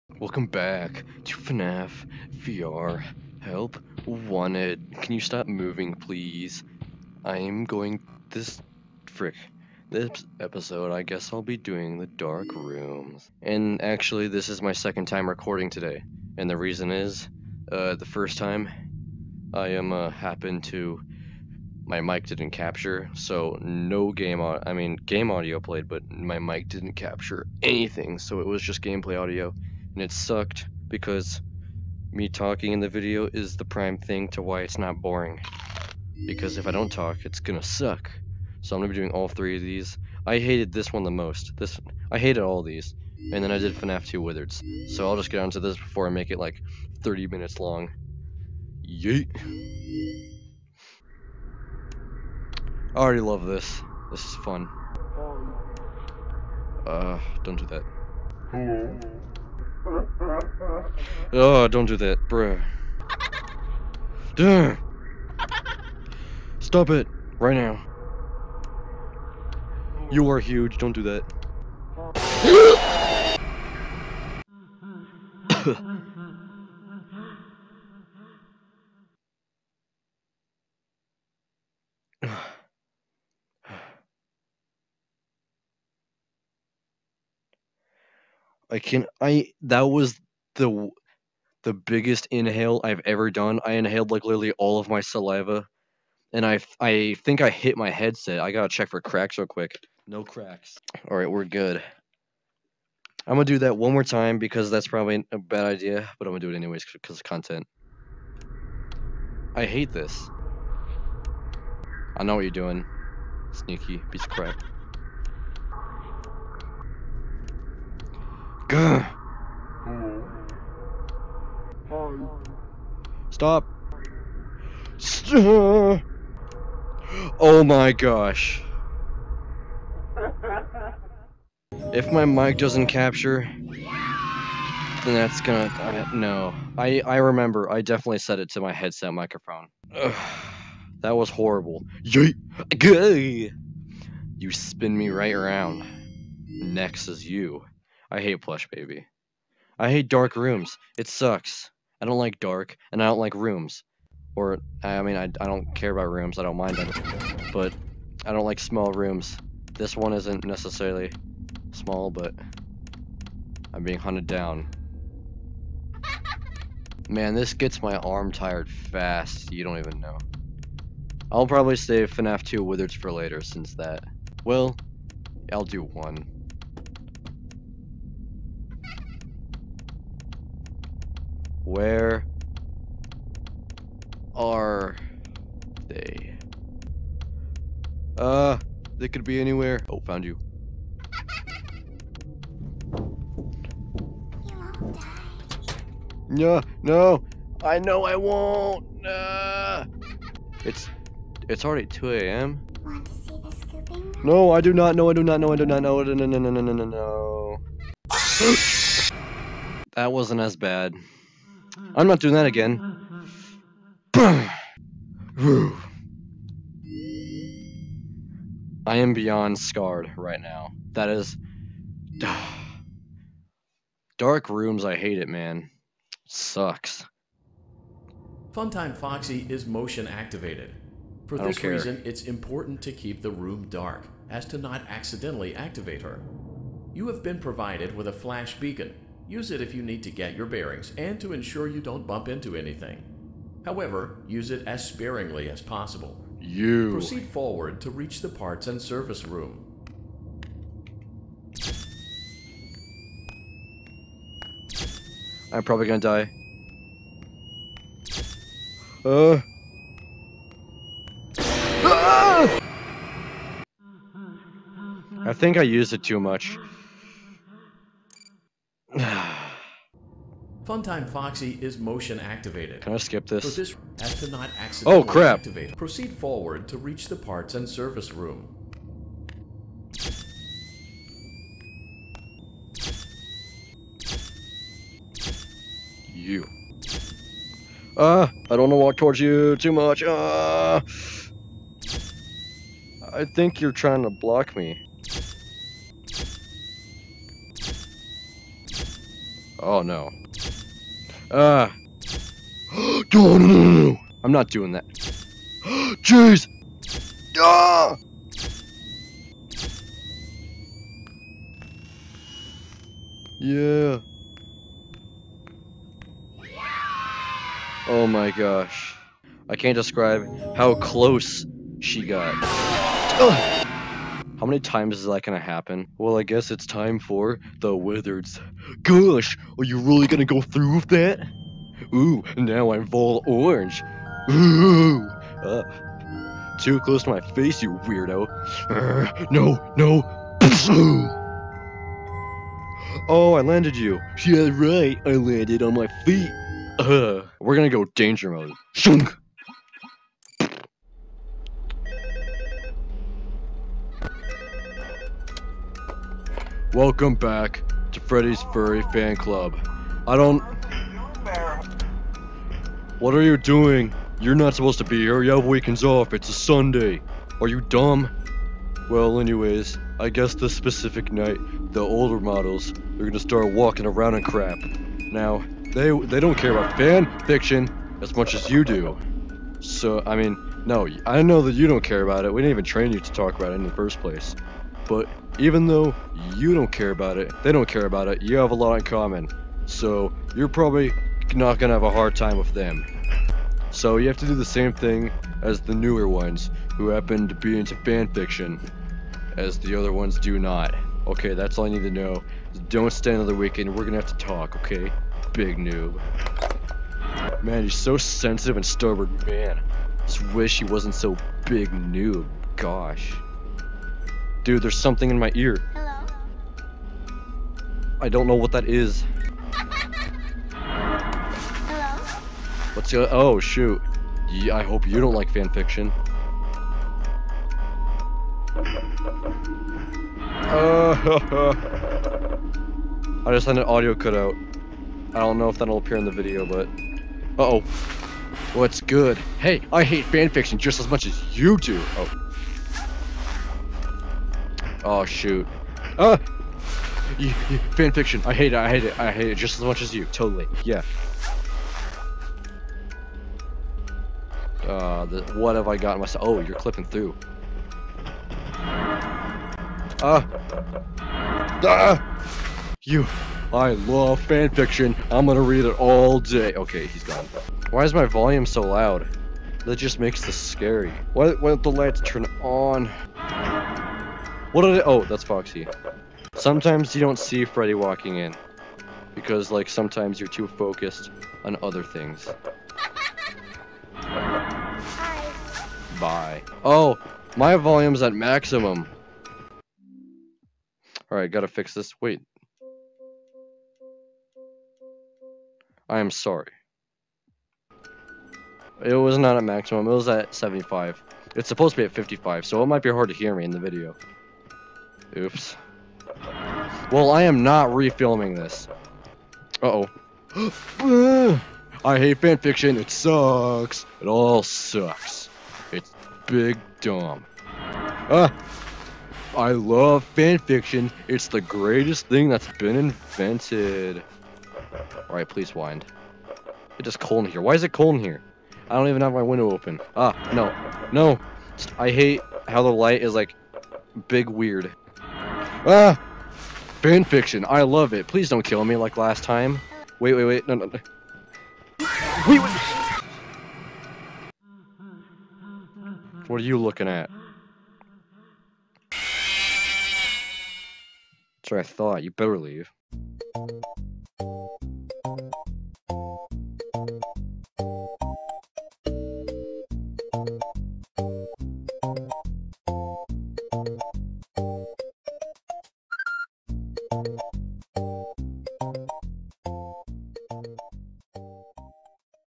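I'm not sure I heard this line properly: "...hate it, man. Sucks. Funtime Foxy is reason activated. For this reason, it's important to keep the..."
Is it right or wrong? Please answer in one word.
wrong.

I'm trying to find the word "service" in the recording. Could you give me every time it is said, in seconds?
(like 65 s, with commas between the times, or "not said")
248 s, 277 s.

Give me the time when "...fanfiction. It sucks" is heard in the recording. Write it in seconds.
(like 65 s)
512 s.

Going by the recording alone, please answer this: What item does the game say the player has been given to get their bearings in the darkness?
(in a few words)
flash beacon.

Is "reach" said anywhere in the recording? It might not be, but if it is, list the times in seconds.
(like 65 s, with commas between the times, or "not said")
247 s, 276 s.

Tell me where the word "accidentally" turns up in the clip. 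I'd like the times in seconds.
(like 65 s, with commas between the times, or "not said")
234 s, 274 s.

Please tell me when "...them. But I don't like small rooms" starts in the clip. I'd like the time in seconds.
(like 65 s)
156 s.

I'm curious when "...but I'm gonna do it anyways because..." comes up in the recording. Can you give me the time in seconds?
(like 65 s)
106 s.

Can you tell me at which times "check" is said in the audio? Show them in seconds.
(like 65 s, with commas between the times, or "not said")
98 s.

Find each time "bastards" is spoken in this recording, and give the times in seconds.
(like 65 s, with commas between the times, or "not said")
not said.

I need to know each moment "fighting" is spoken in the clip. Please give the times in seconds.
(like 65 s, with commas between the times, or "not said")
not said.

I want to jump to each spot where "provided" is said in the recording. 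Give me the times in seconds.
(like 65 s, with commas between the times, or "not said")
237 s.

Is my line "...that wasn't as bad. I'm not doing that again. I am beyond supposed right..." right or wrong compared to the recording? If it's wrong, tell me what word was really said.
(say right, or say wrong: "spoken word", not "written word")
wrong: "scarred", not "supposed".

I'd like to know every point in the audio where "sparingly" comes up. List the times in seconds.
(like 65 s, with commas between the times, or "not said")
244 s.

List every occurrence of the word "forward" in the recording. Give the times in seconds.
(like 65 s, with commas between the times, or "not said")
247 s, 276 s.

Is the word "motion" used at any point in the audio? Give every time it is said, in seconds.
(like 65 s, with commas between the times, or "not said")
229 s, 271 s.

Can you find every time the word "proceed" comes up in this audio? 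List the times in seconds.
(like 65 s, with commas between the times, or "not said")
246 s, 275 s.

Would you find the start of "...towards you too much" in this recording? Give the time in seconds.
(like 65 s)
288 s.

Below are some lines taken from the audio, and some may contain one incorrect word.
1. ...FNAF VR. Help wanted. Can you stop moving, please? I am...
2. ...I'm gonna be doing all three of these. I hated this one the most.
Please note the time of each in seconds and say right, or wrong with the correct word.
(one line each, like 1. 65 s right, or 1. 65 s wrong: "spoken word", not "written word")
1. 1 s right
2. 38 s right.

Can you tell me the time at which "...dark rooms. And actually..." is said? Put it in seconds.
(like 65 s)
12 s.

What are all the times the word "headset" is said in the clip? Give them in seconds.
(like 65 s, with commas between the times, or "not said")
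97 s, 138 s.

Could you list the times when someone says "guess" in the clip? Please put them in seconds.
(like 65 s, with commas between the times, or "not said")
11 s, 326 s, 370 s.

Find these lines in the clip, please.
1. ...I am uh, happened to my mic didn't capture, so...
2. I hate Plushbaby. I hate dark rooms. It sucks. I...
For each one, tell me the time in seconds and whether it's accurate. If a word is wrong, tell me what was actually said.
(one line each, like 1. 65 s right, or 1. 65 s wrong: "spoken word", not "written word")
1. 19 s right
2. 148 s right.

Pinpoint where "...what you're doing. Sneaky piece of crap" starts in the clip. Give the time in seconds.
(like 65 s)
112 s.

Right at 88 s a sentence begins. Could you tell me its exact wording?
I can I that was the the biggest inhale I've ever done.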